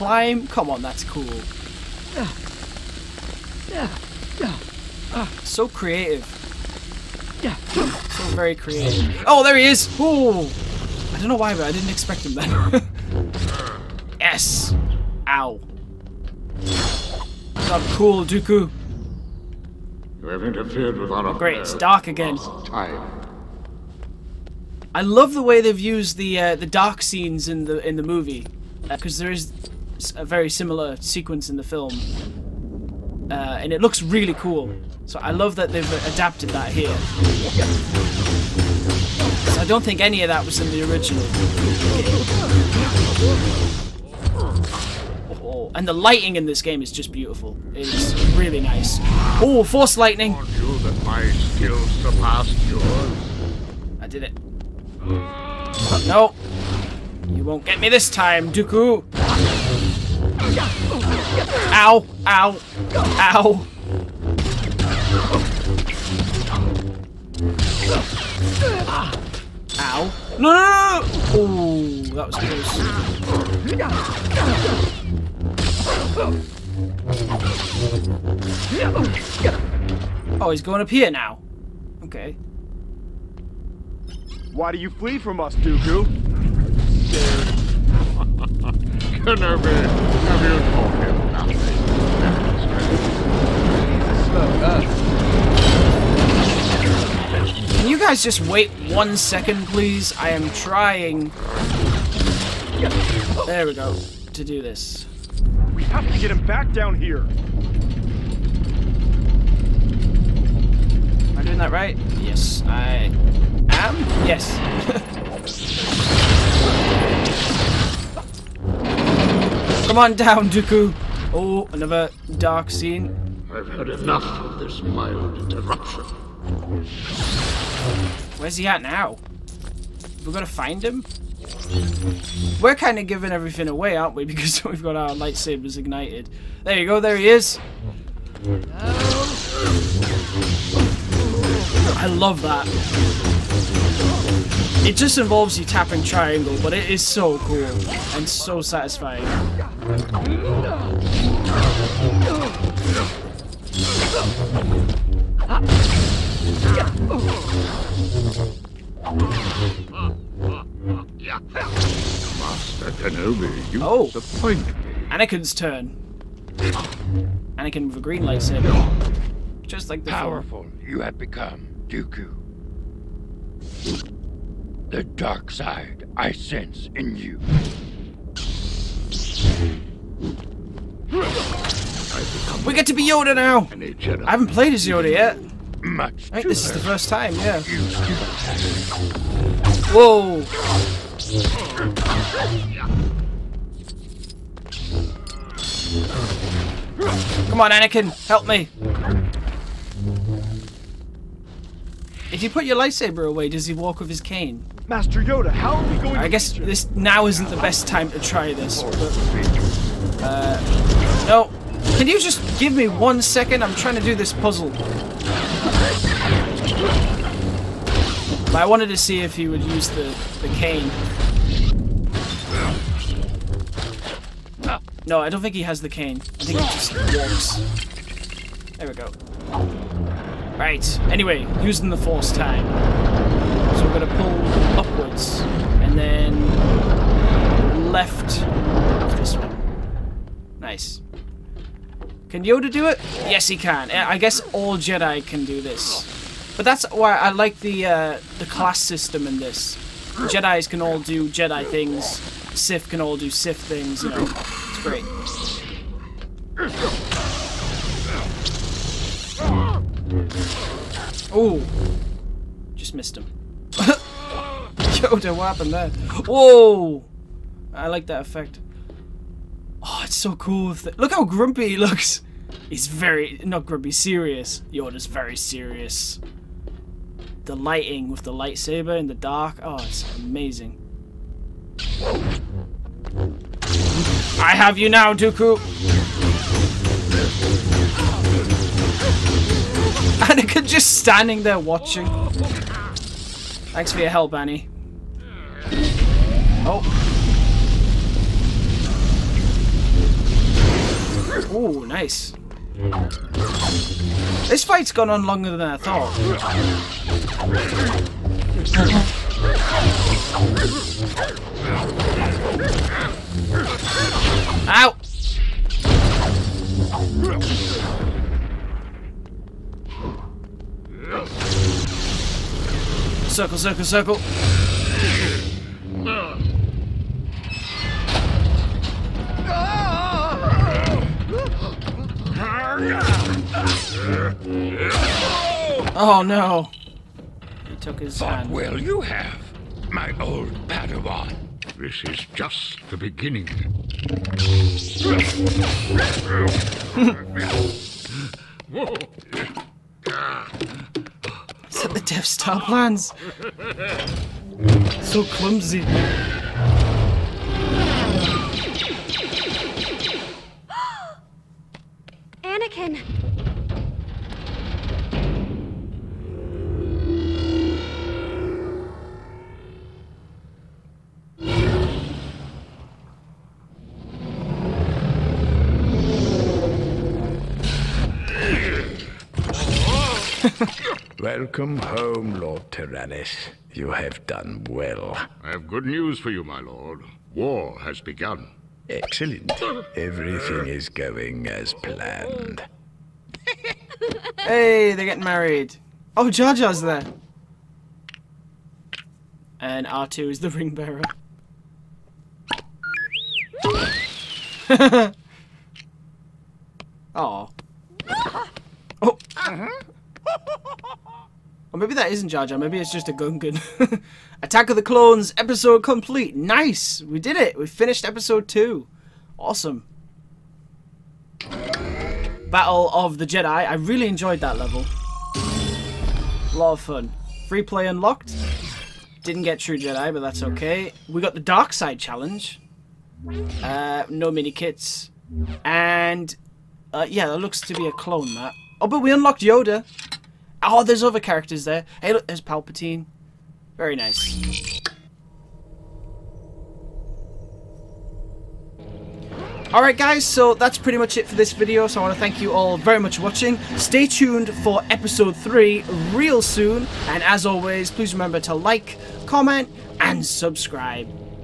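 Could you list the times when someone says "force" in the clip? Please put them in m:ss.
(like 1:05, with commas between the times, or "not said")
0:49, 3:51.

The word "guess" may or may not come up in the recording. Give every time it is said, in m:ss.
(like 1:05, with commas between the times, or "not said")
3:26, 4:04.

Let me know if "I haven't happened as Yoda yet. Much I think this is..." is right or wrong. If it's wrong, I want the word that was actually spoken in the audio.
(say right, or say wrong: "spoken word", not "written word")
wrong: "played", not "happened".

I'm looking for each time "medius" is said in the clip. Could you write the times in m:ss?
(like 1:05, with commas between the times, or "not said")
not said.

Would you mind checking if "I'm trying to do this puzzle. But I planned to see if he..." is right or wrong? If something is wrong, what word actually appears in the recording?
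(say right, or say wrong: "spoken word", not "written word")
wrong: "wanted", not "planned".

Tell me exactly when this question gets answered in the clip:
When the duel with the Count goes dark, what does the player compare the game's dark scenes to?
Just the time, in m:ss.
0:31.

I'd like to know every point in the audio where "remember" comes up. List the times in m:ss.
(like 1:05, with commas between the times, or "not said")
7:38.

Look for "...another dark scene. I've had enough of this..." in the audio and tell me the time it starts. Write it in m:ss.
2:01.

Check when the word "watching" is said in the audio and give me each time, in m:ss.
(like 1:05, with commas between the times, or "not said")
4:51, 7:33.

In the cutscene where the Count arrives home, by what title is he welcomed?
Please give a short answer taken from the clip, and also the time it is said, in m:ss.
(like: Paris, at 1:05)
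Lord Tyrannus, at 6:22.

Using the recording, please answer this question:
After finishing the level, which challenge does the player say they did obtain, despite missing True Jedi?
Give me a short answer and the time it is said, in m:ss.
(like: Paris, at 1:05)
Dark Side Challenge, at 7:11.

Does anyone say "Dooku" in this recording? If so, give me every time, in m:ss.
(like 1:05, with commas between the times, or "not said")
0:18, 0:58, 1:25, 2:00, 2:51, 4:45.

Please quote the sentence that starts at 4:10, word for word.
Jedis can all do Jedi things.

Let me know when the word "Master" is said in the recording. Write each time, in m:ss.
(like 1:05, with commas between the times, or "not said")
2:29, 3:24.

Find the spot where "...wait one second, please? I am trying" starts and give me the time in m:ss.
1:38.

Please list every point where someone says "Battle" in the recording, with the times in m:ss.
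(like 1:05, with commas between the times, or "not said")
7:02.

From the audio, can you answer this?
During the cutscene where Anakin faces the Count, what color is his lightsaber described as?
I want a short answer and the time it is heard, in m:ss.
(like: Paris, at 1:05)
green, at 2:48.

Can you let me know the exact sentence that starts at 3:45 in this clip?
No, I don't think he has the cane.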